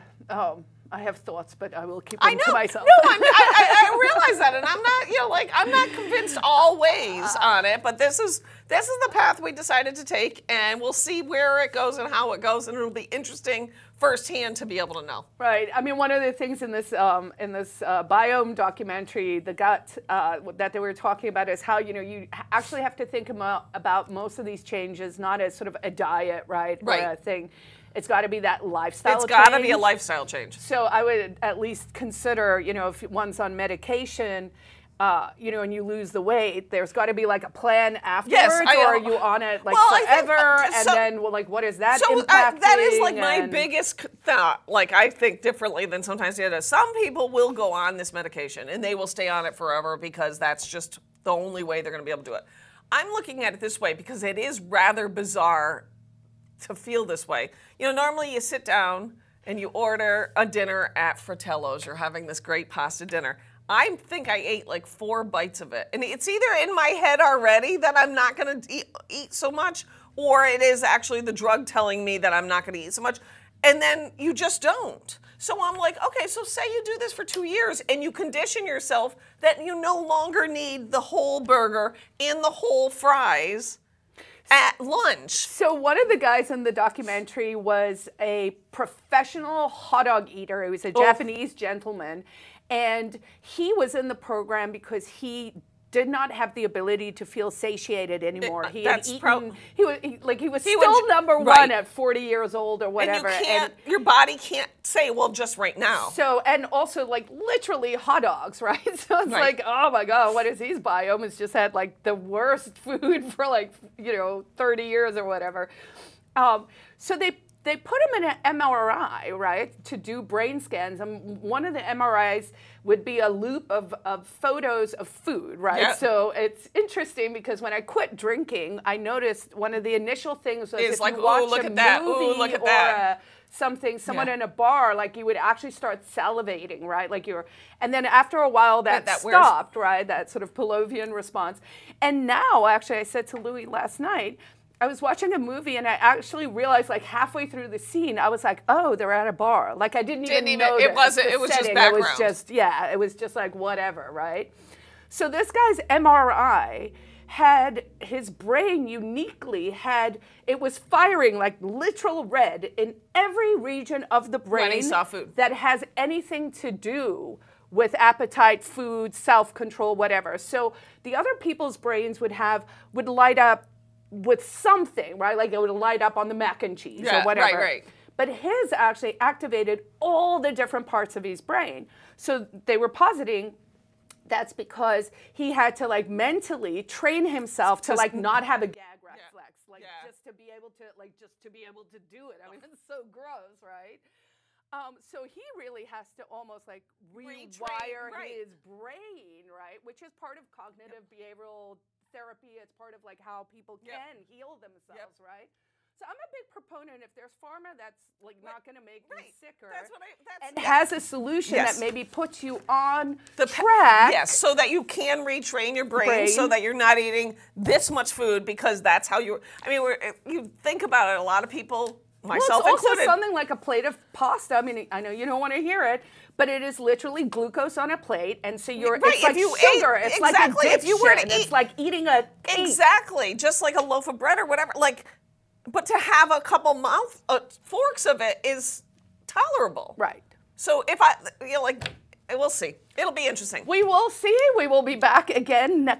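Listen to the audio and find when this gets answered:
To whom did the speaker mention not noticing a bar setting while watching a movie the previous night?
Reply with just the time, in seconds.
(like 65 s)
143 s.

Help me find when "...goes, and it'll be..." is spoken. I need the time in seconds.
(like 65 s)
12 s.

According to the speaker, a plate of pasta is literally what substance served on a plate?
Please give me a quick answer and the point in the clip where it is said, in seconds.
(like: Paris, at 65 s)
Glucose, at 227 s.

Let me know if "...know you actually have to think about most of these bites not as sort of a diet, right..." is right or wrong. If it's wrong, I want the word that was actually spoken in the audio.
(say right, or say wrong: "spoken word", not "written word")
wrong: "changes", not "bites".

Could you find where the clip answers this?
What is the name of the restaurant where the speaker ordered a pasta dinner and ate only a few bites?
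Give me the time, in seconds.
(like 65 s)
61 s.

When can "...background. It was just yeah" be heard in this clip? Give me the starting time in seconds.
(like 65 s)
151 s.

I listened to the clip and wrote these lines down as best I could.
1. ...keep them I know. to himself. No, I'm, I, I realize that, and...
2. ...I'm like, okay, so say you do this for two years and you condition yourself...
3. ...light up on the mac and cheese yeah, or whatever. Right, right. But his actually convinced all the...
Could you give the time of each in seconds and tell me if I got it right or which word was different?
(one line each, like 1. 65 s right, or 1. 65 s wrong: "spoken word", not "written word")
1. 1 s wrong: "myself", not "himself"
2. 75 s right
3. 175 s wrong: "activated", not "convinced".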